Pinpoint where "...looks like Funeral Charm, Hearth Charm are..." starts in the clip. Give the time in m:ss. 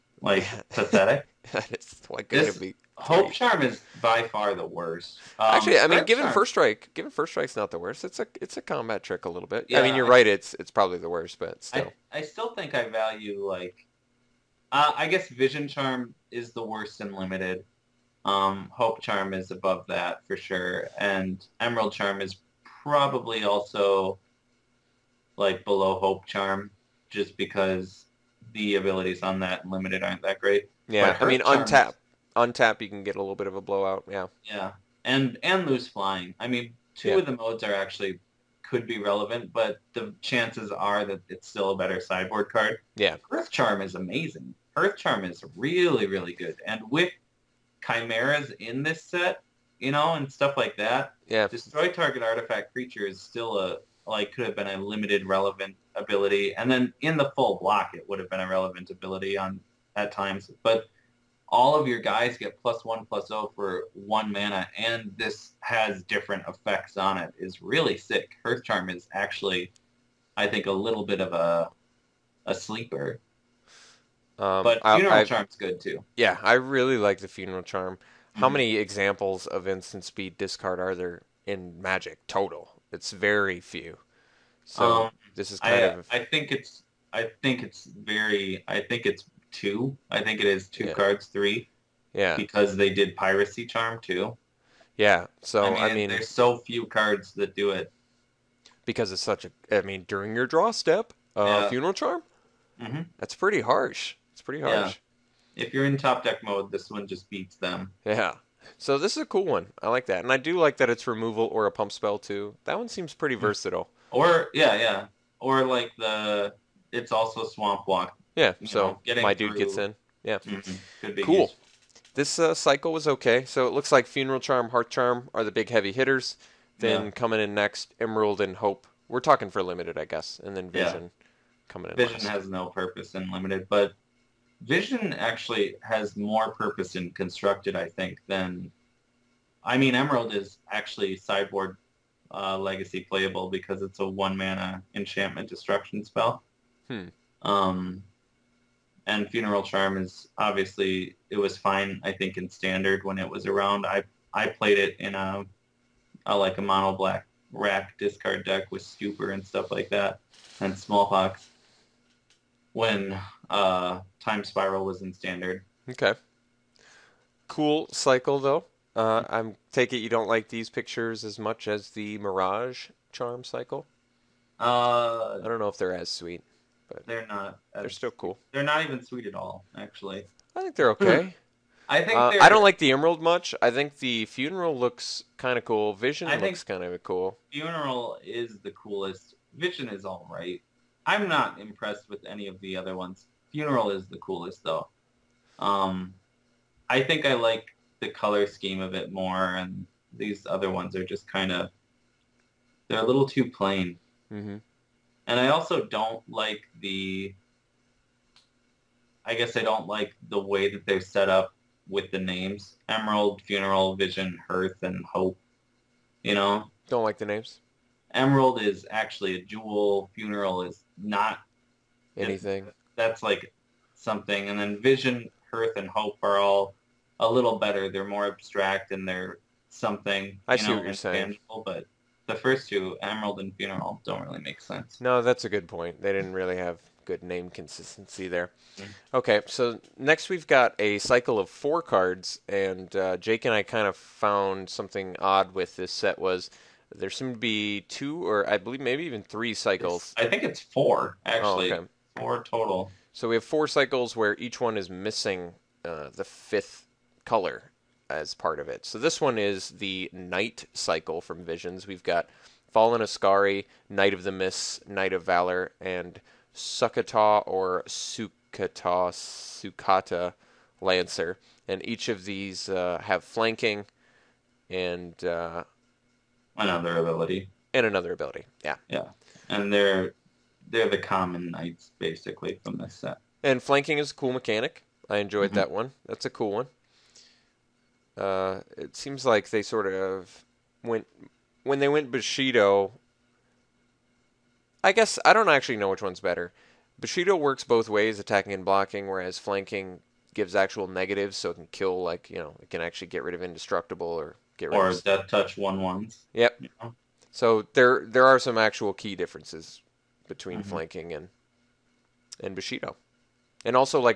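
2:03.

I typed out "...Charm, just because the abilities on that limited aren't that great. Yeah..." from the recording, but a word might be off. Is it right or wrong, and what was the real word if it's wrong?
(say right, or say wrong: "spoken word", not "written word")
right.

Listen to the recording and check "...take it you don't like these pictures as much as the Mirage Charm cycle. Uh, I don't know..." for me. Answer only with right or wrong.
right.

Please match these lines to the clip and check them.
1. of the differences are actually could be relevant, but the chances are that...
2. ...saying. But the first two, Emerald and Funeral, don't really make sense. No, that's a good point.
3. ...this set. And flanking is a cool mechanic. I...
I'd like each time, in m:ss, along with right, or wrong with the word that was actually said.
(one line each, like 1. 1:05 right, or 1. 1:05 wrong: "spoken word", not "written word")
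1. 0:37 wrong: "modes", not "differences"
2. 3:50 right
3. 4:42 right.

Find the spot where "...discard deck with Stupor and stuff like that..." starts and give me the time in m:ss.
2:37.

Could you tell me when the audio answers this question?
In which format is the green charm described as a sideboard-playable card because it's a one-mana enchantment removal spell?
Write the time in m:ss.
2:22.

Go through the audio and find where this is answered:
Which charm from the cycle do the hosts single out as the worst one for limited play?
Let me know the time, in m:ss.
0:15.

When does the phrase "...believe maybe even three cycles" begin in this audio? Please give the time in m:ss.
4:08.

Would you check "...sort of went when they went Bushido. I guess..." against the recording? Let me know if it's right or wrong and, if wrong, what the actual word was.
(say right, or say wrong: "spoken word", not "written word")
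right.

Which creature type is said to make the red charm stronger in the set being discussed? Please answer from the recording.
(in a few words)
chimeras.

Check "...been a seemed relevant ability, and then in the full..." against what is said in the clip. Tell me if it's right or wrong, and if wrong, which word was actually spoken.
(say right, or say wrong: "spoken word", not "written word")
wrong: "limited", not "seemed".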